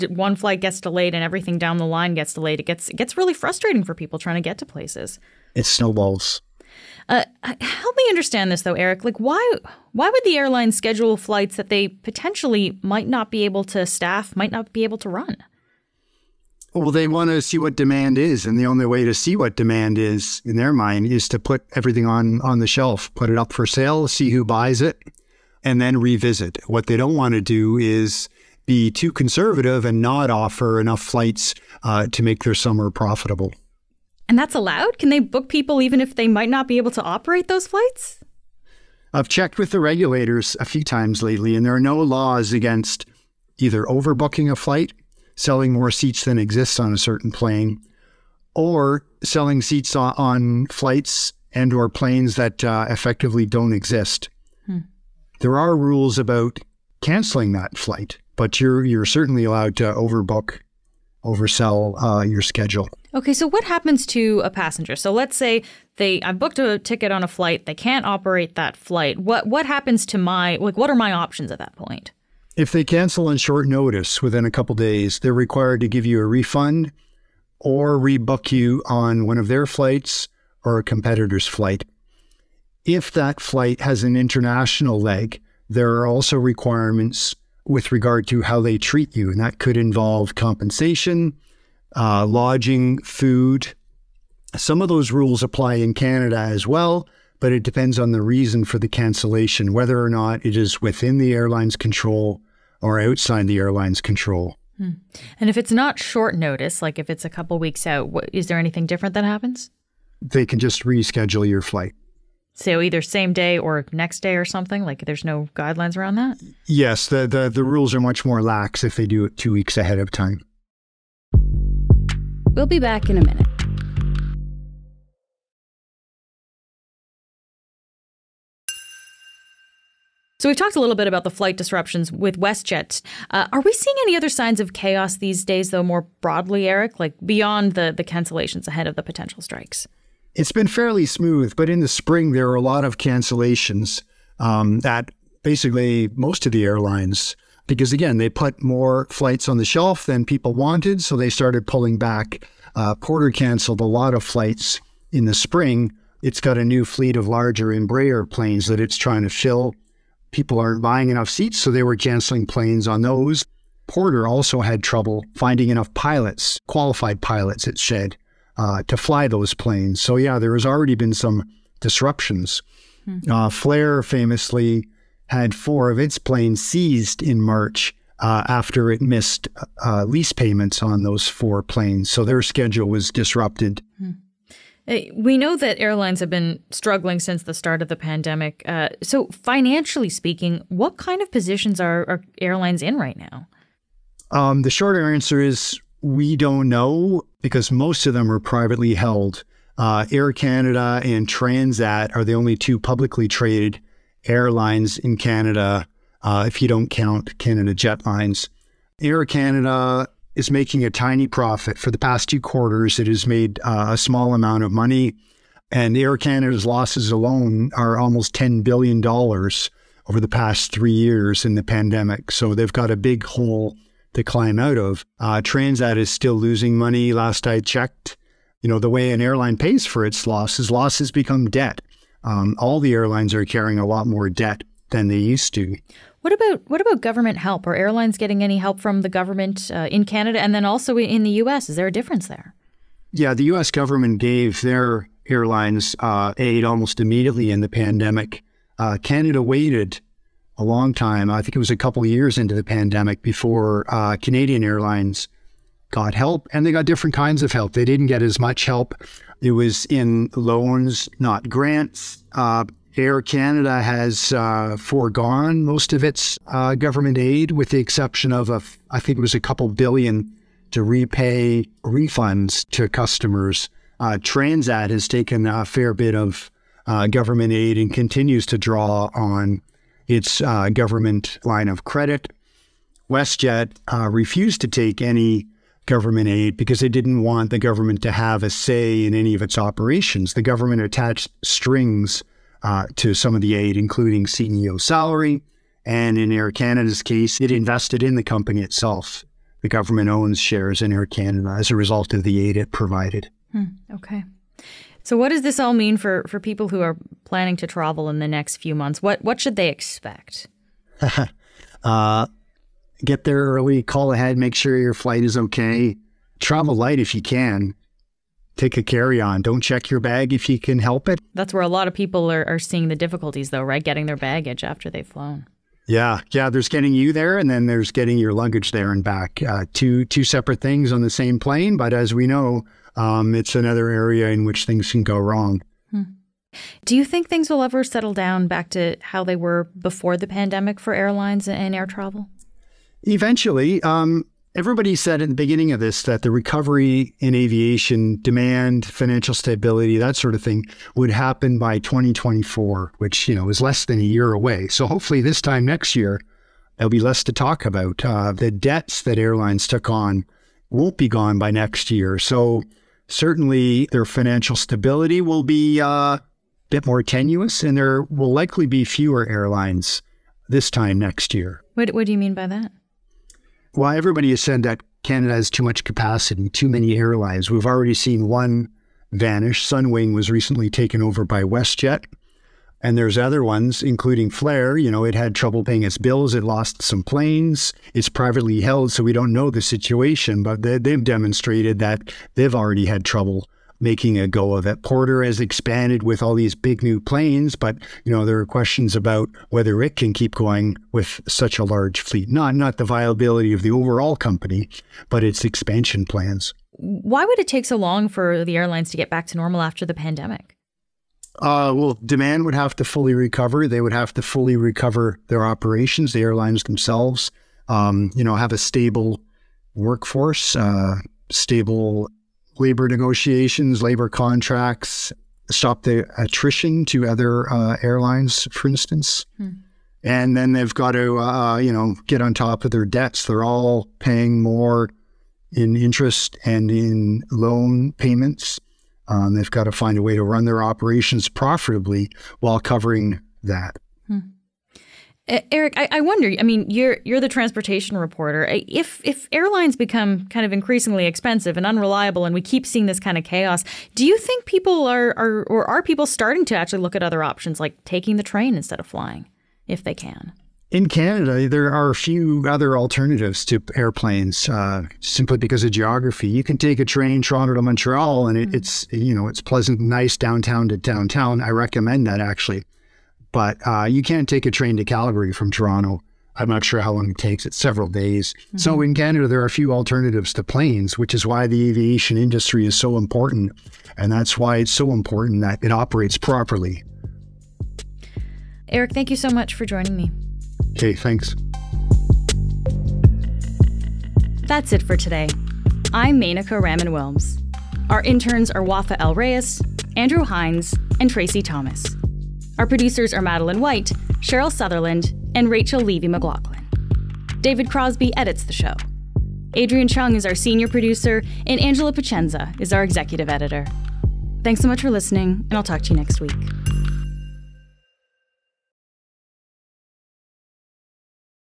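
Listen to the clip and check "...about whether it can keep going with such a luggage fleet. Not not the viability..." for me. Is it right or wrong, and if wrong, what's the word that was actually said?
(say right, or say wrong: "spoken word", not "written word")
wrong: "large", not "luggage".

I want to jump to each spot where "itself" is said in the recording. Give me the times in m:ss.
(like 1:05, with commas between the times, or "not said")
4:58.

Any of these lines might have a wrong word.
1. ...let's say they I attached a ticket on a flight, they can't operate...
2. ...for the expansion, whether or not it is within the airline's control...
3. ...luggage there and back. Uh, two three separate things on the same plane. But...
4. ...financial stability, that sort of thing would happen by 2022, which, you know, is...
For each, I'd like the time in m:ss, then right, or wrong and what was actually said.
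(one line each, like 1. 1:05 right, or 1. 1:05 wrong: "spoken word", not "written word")
1. 1:05 wrong: "booked", not "attached"
2. 1:38 wrong: "cancellation", not "expansion"
3. 5:28 wrong: "two", not "three"
4. 5:48 wrong: "2024", not "2022".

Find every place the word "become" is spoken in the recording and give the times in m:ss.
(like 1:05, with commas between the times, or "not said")
3:51, 7:29.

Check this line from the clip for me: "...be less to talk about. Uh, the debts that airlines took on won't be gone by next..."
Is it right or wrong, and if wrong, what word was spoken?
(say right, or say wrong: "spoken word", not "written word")
right.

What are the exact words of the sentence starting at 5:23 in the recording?
Getting their baggage after they've flown.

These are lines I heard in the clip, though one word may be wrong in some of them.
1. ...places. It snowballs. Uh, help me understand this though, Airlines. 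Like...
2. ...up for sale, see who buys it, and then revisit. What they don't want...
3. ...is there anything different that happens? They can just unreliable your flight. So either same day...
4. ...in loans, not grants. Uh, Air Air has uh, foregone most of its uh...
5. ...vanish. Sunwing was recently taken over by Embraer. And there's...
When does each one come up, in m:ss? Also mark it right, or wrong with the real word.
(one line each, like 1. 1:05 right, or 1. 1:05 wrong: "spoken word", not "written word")
1. 0:04 wrong: "Eric", not "Airlines"
2. 0:23 right
3. 1:48 wrong: "reschedule", not "unreliable"
4. 4:19 wrong: "Canada", not "Air"
5. 6:19 wrong: "WestJet", not "Embraer".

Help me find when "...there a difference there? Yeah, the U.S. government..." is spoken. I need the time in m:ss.
4:01.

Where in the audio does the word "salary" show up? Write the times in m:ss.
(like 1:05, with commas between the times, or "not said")
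4:54.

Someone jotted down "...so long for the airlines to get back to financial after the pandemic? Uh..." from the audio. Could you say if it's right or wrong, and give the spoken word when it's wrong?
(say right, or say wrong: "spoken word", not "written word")
wrong: "normal", not "financial".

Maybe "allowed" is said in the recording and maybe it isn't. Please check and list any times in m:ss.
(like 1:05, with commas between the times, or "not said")
0:34, 0:59.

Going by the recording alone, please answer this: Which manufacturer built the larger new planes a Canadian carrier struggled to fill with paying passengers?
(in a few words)
Embraer.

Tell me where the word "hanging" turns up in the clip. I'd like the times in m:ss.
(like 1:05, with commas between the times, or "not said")
not said.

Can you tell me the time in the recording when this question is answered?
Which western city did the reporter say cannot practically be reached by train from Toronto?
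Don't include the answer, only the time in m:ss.
7:54.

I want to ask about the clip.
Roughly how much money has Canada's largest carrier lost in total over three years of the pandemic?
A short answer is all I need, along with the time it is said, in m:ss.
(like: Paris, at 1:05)
almost $10 billion, at 3:37.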